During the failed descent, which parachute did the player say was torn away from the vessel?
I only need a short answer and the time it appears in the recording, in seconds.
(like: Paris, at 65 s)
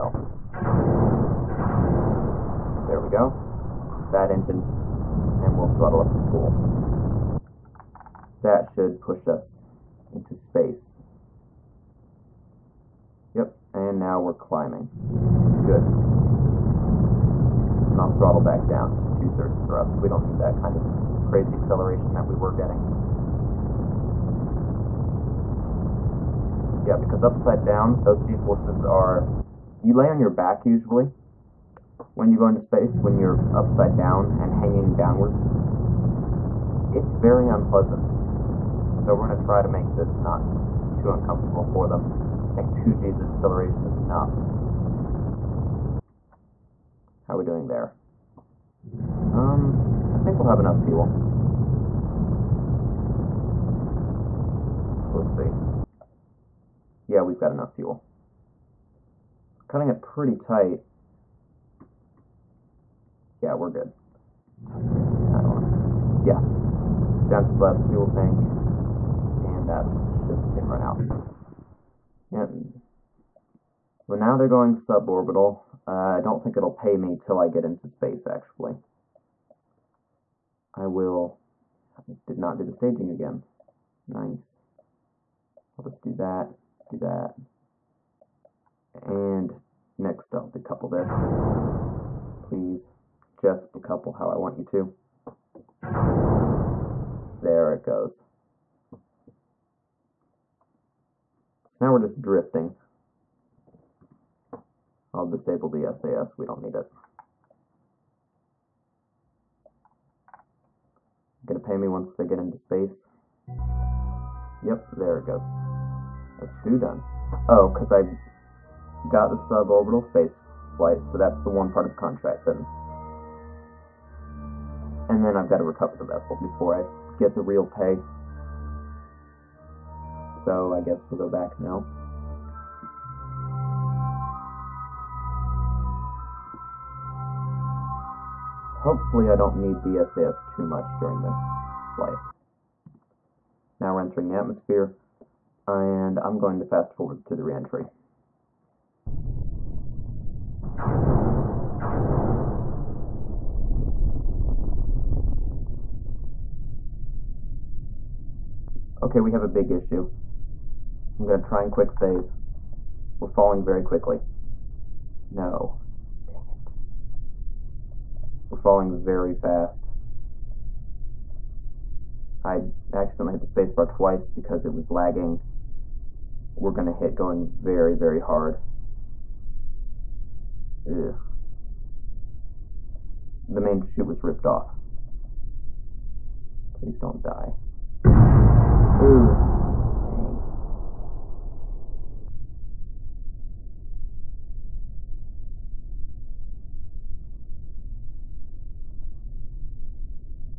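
main chute, at 183 s.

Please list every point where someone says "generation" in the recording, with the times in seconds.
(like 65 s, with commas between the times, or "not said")
not said.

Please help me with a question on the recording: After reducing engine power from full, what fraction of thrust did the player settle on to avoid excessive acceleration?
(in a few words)
two-thirds.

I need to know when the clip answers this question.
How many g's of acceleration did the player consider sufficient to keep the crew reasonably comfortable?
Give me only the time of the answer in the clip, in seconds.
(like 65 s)
42 s.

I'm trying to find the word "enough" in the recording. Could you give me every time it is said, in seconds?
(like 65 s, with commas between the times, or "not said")
43 s, 50 s, 57 s.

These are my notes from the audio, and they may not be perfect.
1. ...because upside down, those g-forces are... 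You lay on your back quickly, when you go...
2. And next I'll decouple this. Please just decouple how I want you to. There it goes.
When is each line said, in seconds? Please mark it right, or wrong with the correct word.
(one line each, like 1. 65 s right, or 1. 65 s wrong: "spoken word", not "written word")
1. 26 s wrong: "usually", not "quickly"
2. 88 s right.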